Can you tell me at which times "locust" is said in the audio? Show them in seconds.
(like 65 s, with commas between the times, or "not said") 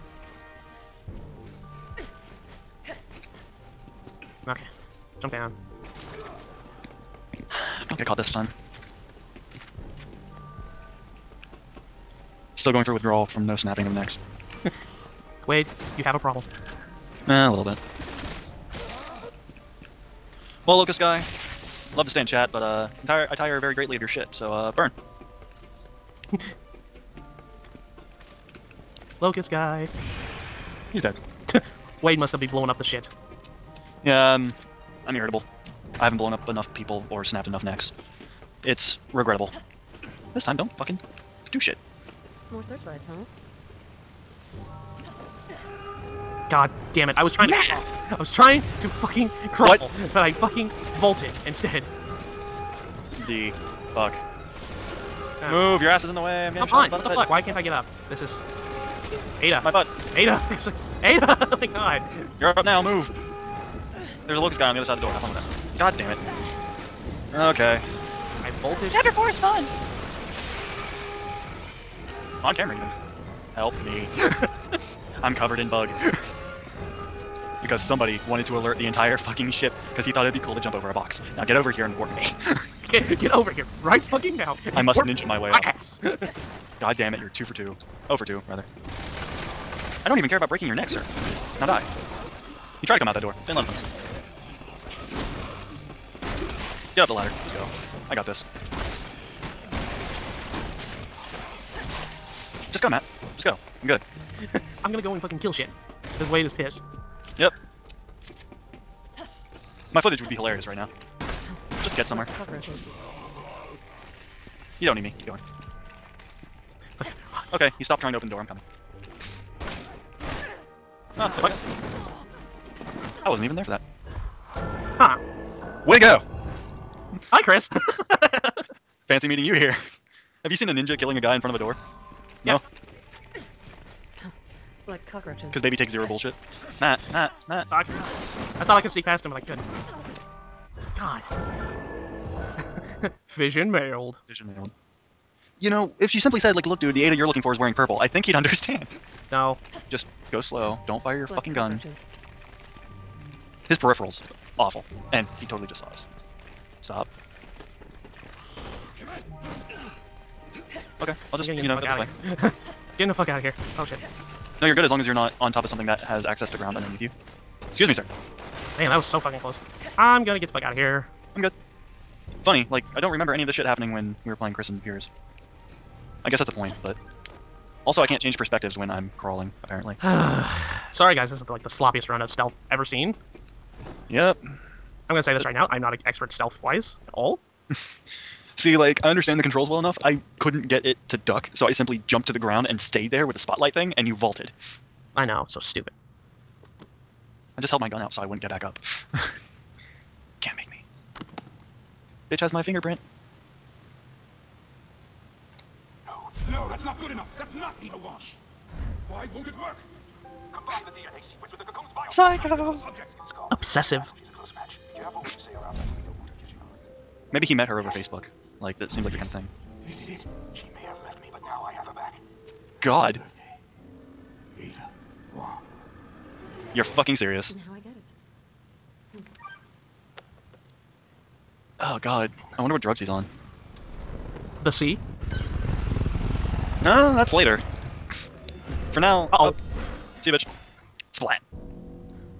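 20 s, 29 s, 64 s.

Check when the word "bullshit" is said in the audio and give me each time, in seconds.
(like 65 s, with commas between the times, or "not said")
136 s.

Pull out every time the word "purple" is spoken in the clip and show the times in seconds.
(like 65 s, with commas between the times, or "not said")
147 s.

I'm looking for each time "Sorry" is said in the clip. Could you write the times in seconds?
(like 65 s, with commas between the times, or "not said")
180 s.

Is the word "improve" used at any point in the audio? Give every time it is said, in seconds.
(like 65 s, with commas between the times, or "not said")
not said.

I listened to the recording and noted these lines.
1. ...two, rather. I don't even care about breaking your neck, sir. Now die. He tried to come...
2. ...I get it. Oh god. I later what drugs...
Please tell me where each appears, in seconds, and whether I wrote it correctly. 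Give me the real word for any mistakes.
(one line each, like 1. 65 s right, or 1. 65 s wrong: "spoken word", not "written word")
1. 88 s right
2. 227 s wrong: "wonder", not "later".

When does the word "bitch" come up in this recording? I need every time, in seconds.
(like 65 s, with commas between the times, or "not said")
202 s, 240 s.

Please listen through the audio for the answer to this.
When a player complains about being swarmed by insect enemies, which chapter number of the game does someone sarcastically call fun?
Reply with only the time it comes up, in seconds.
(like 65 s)
68 s.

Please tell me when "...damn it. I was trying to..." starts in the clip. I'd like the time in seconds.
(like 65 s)
46 s.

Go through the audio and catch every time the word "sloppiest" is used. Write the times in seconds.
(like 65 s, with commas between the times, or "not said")
181 s.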